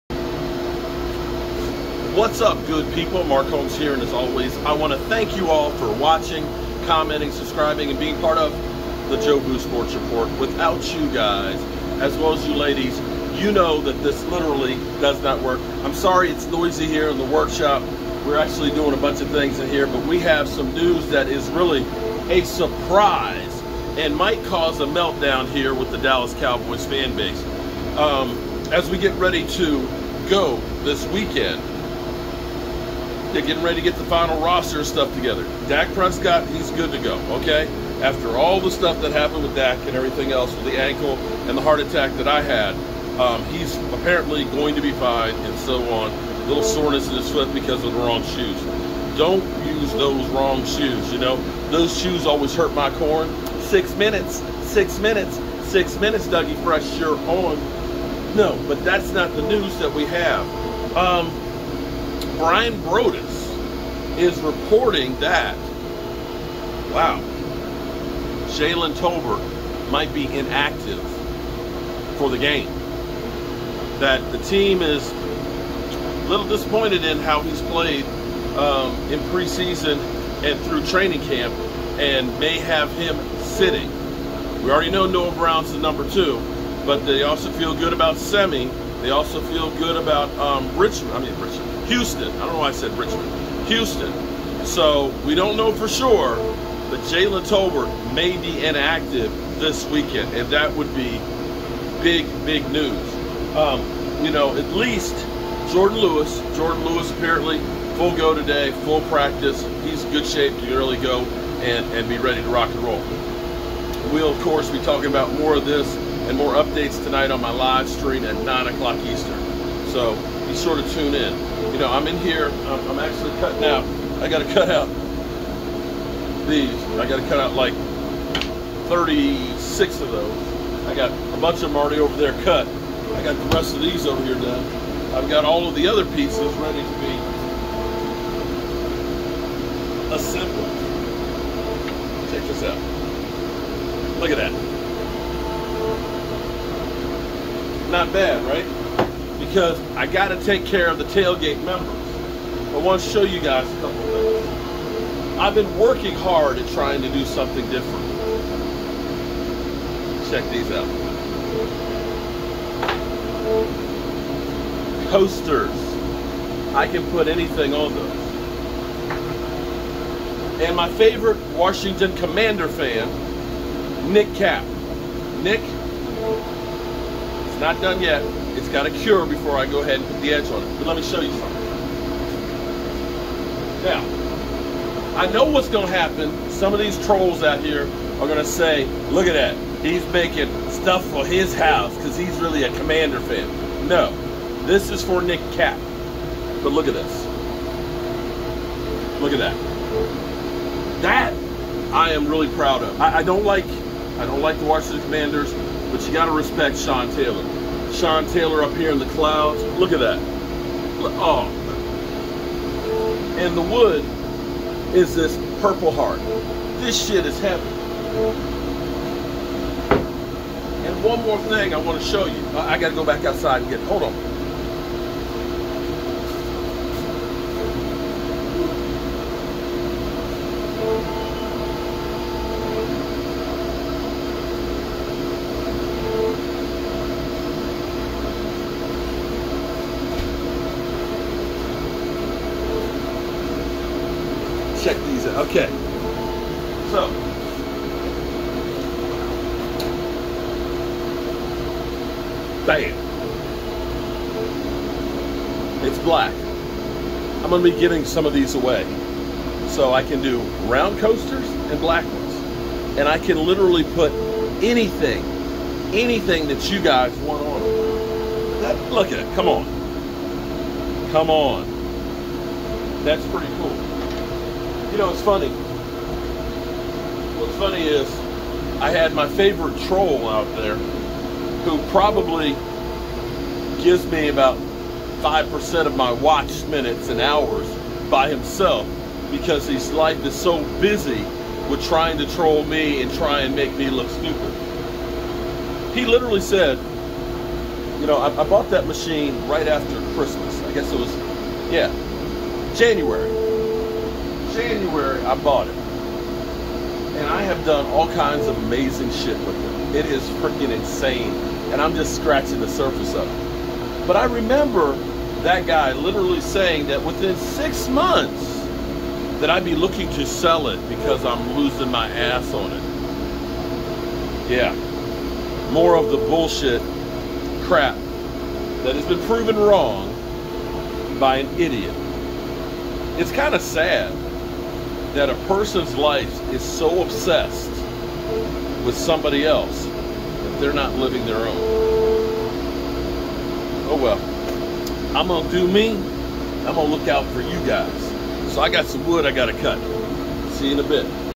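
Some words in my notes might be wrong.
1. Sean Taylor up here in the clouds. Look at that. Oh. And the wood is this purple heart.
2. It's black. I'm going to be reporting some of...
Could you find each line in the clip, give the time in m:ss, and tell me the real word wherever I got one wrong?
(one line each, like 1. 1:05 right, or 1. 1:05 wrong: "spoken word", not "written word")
1. 3:27 right
2. 4:15 wrong: "giving", not "reporting".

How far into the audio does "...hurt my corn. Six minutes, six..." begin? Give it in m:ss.
0:52.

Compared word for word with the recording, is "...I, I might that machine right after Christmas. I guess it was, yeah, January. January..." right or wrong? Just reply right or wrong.
wrong.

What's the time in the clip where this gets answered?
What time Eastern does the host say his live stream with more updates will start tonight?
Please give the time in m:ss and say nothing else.
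1:58.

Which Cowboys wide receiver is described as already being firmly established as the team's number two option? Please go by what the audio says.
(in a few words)
Noah Brown.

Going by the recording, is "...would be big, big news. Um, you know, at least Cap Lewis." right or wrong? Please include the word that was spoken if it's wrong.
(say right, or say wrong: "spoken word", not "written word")
wrong: "Jourdan", not "Cap".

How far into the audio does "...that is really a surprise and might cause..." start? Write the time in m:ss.
0:21.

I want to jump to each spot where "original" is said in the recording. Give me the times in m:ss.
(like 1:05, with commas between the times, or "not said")
not said.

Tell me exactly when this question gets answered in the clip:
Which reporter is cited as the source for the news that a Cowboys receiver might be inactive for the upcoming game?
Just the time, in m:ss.
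1:02.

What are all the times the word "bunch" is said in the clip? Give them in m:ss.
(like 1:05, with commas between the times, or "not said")
0:18, 2:11.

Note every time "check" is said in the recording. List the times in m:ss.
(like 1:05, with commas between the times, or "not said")
2:22, 2:40, 4:04.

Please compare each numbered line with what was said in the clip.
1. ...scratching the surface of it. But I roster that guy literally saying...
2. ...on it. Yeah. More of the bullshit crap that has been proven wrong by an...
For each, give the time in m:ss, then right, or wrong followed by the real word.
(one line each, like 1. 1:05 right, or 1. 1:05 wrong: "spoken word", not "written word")
1. 5:12 wrong: "remember", not "roster"
2. 5:22 right.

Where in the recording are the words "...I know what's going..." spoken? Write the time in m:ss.
3:05.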